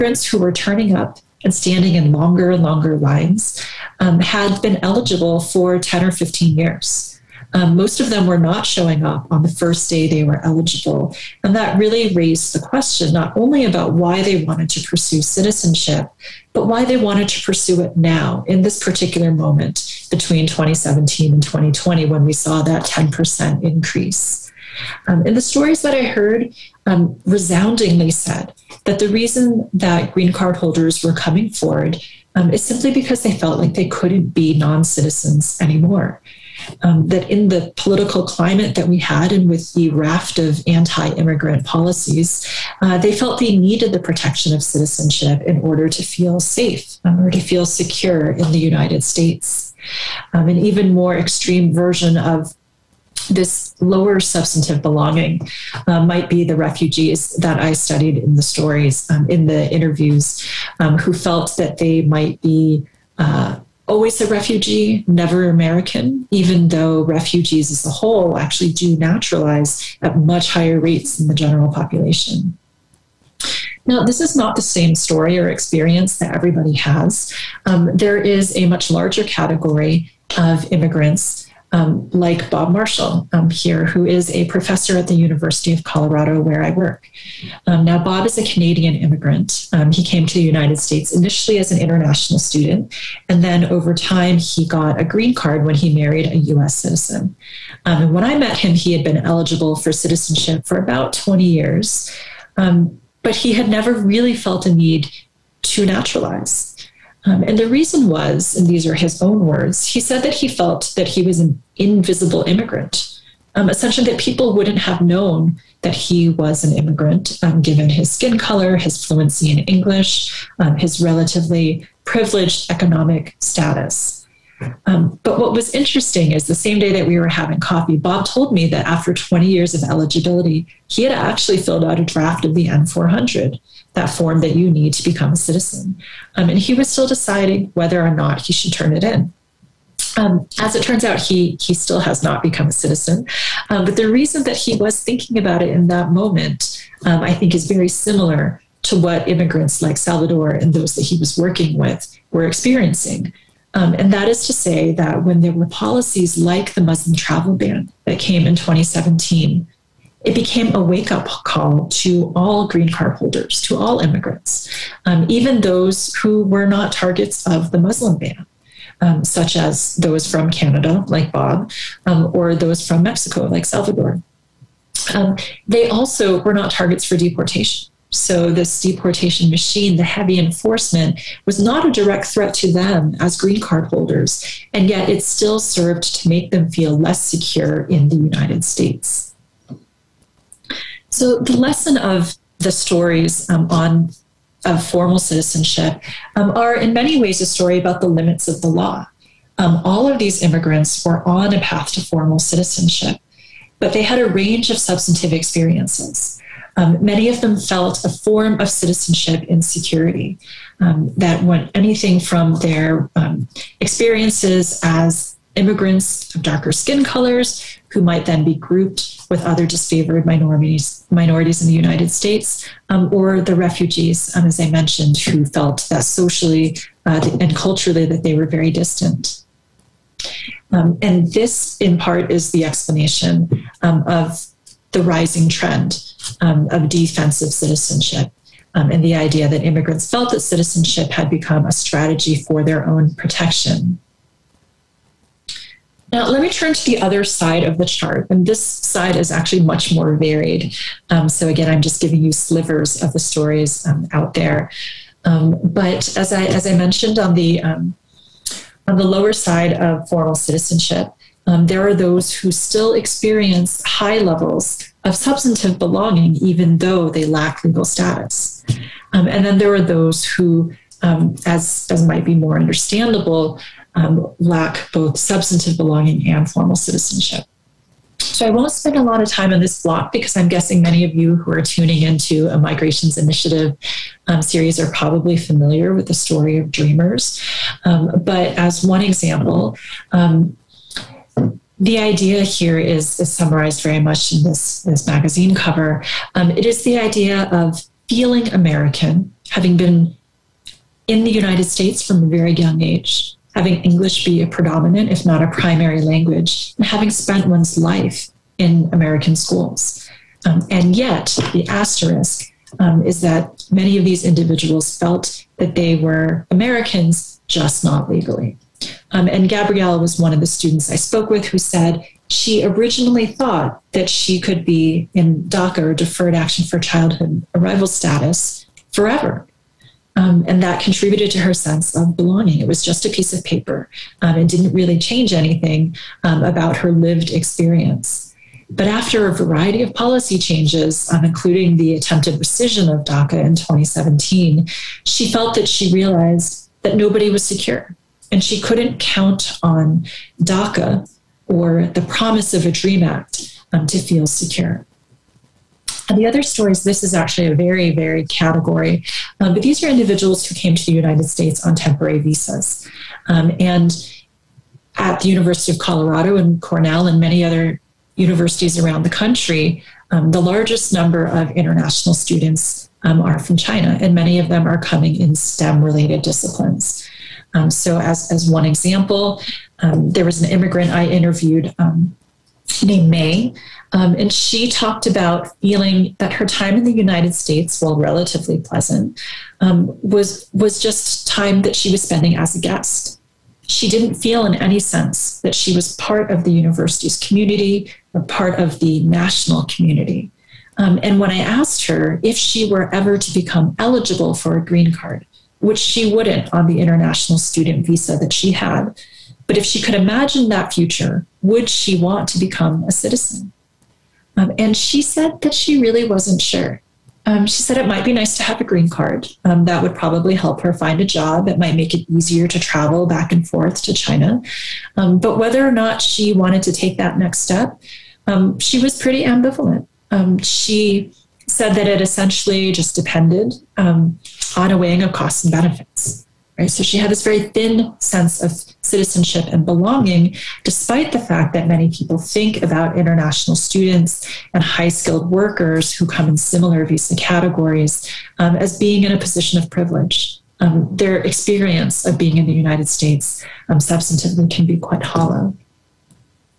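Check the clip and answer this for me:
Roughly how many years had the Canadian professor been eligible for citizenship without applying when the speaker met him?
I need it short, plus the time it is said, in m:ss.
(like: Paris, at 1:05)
20 years, at 1:40.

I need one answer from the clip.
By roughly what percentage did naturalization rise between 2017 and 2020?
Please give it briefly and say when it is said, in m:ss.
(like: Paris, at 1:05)
10%, at 0:22.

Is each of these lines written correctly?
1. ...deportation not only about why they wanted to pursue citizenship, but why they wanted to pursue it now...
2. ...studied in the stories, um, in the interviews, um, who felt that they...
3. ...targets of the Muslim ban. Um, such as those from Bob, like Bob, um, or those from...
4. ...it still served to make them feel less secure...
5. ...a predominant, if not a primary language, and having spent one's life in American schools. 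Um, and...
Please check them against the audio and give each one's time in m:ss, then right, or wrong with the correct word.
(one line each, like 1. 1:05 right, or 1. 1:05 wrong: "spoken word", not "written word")
1. 0:12 wrong: "question", not "deportation"
2. 0:57 right
3. 2:46 wrong: "Canada", not "Bob"
4. 3:05 right
5. 5:04 right.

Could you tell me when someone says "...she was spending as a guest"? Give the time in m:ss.
6:31.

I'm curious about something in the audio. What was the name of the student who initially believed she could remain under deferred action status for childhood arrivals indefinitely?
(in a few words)
Gabrielle.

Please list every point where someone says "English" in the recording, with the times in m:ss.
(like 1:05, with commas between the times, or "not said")
1:59, 5:03.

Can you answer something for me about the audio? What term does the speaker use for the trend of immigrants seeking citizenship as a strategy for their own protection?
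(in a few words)
defensive citizenship.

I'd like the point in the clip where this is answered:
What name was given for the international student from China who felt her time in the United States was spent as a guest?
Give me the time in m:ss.
6:23.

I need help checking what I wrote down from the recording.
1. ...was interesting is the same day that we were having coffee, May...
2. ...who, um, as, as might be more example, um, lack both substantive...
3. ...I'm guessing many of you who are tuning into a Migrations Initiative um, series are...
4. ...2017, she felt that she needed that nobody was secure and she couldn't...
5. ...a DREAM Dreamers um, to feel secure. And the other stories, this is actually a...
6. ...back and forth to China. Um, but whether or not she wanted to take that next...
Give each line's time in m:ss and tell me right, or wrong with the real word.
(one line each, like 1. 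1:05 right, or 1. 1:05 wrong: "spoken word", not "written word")
1. 2:05 wrong: "Bob", not "May"
2. 4:30 wrong: "understandable", not "example"
3. 4:40 right
4. 5:43 wrong: "realized", not "needed"
5. 5:52 wrong: "Act", not "Dreamers"
6. 7:03 right.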